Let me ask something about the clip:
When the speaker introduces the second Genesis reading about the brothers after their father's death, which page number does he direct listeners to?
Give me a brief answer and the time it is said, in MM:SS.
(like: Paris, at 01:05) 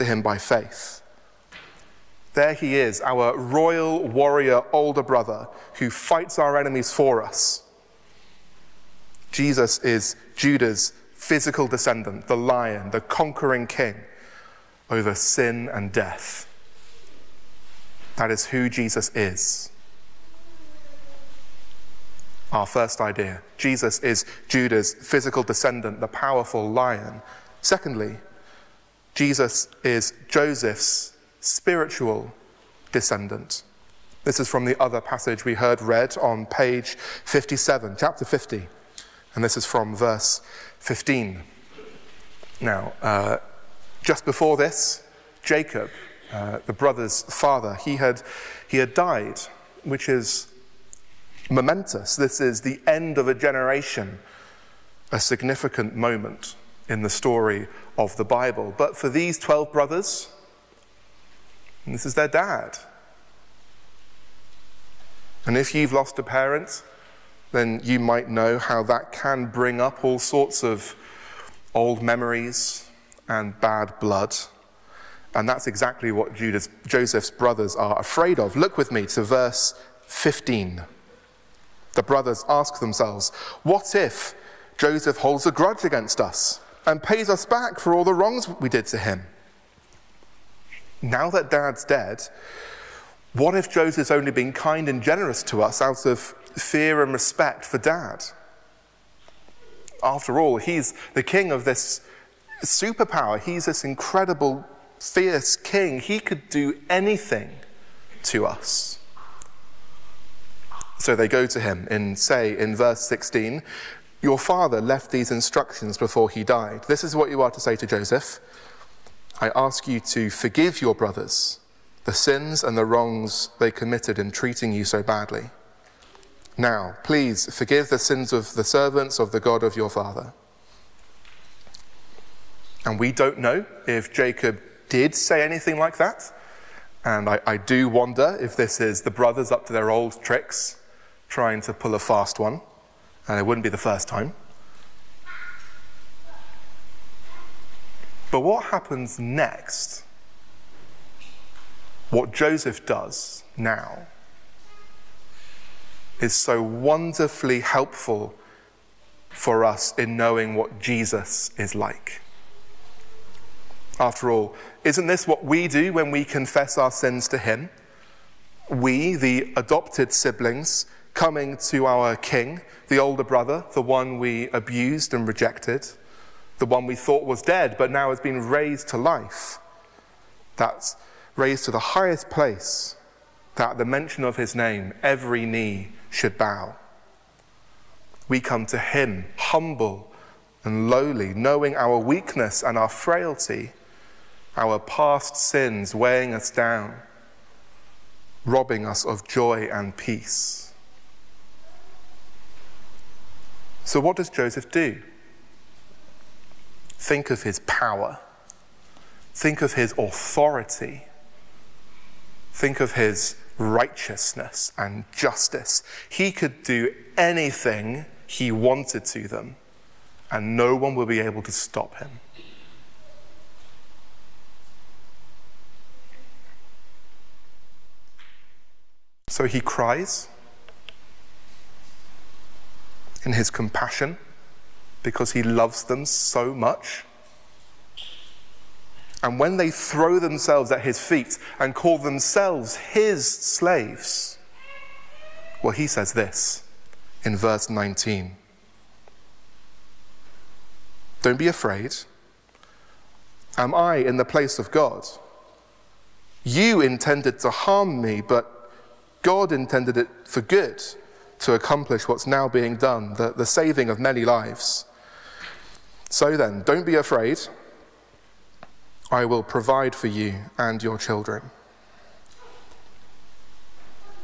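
57, at 00:36.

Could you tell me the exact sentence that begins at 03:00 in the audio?
That's raised to the highest place, that at the mention of His name, every knee should bow.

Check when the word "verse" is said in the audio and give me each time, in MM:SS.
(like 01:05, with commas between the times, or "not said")
00:39, 01:19, 01:52, 04:07.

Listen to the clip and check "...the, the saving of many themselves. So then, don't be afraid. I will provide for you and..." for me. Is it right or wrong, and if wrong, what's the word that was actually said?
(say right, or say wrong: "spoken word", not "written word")
wrong: "lives", not "themselves".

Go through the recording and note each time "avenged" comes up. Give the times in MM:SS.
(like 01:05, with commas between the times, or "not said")
not said.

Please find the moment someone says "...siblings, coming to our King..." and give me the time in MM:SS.
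02:50.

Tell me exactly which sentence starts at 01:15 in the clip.
And that's exactly what Judas, Joseph's brothers are afraid of.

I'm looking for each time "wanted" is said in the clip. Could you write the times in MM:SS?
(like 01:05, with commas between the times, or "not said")
03:38.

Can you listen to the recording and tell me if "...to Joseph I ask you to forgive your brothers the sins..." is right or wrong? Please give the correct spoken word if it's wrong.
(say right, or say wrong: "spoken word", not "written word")
right.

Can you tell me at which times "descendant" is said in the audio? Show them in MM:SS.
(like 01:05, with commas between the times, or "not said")
00:11, 00:25, 00:32.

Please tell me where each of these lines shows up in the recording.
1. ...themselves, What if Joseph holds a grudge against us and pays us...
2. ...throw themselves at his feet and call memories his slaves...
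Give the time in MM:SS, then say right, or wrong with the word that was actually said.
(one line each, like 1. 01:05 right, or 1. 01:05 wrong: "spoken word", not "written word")
1. 01:22 right
2. 03:59 wrong: "themselves", not "memories".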